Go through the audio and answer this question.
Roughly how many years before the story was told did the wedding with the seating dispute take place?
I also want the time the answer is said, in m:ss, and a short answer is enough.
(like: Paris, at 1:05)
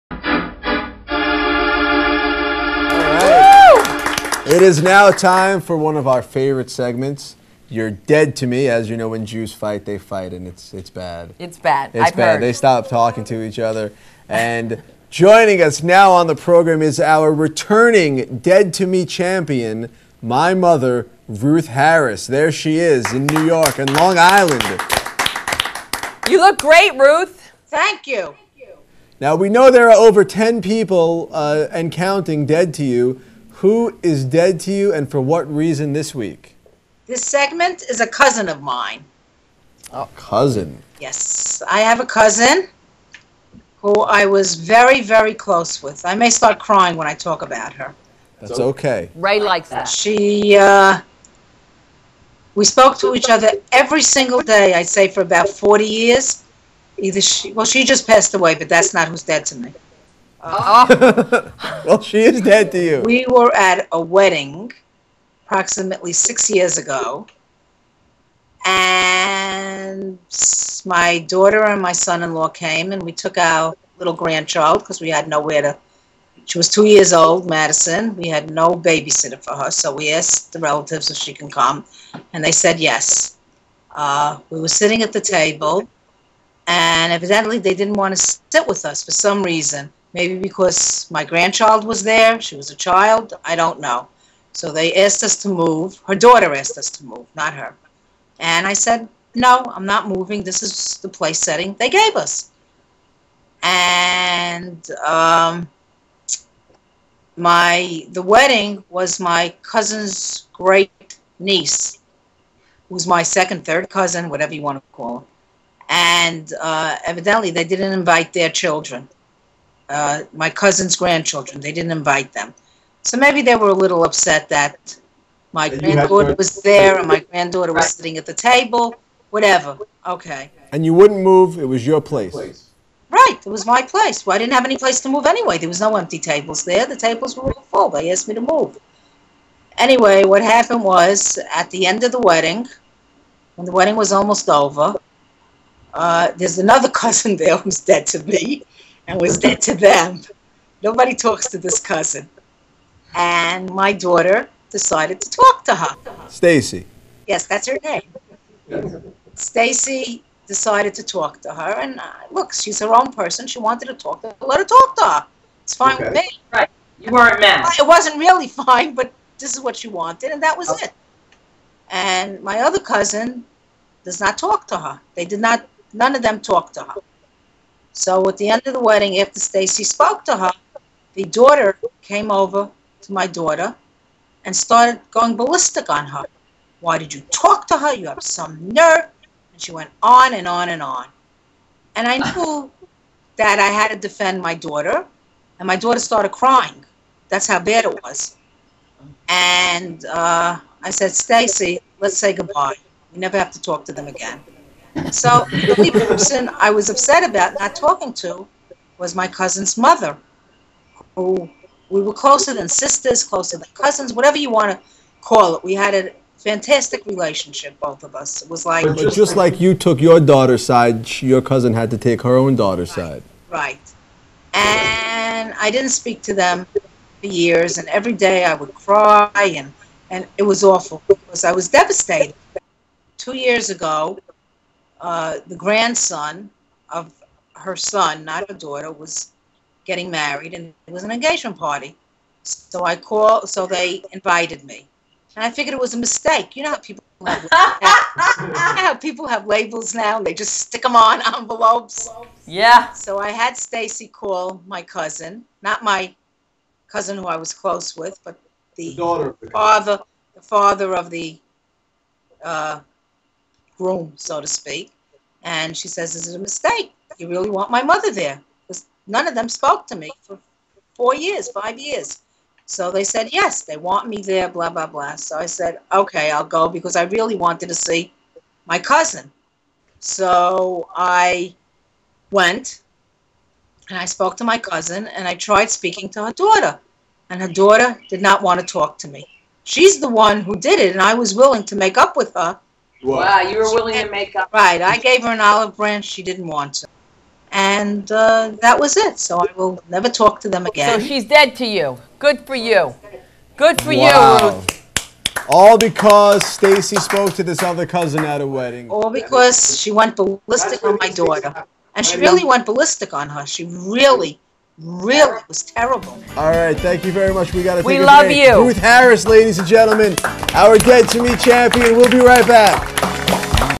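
6, at 1:06.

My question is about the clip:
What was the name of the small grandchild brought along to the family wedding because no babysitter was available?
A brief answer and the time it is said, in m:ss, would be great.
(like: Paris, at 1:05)
Madison, at 1:17.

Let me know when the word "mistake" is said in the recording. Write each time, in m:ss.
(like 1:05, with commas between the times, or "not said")
4:05, 4:26.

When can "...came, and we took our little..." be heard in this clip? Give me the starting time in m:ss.
1:12.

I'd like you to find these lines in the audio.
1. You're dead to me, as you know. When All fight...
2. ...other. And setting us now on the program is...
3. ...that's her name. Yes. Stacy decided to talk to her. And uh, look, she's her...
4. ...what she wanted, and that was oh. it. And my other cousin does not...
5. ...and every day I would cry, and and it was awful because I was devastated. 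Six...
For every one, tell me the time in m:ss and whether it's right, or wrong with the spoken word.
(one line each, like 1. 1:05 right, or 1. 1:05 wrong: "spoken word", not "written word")
1. 0:07 wrong: "Jews", not "All"
2. 0:13 wrong: "joining", not "setting"
3. 2:37 right
4. 2:49 right
5. 3:47 wrong: "Two", not "Six".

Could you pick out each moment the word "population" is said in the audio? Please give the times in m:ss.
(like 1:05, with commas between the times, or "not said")
not said.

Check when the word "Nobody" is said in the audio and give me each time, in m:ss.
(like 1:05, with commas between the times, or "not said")
2:30.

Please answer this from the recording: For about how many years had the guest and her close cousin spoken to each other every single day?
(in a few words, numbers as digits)
40.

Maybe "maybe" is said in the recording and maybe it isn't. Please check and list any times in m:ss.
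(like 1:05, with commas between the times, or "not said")
1:30, 2:03.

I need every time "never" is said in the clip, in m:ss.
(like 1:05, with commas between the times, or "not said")
3:23, 4:59.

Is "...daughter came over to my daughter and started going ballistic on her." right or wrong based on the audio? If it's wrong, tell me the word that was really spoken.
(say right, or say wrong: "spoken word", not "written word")
right.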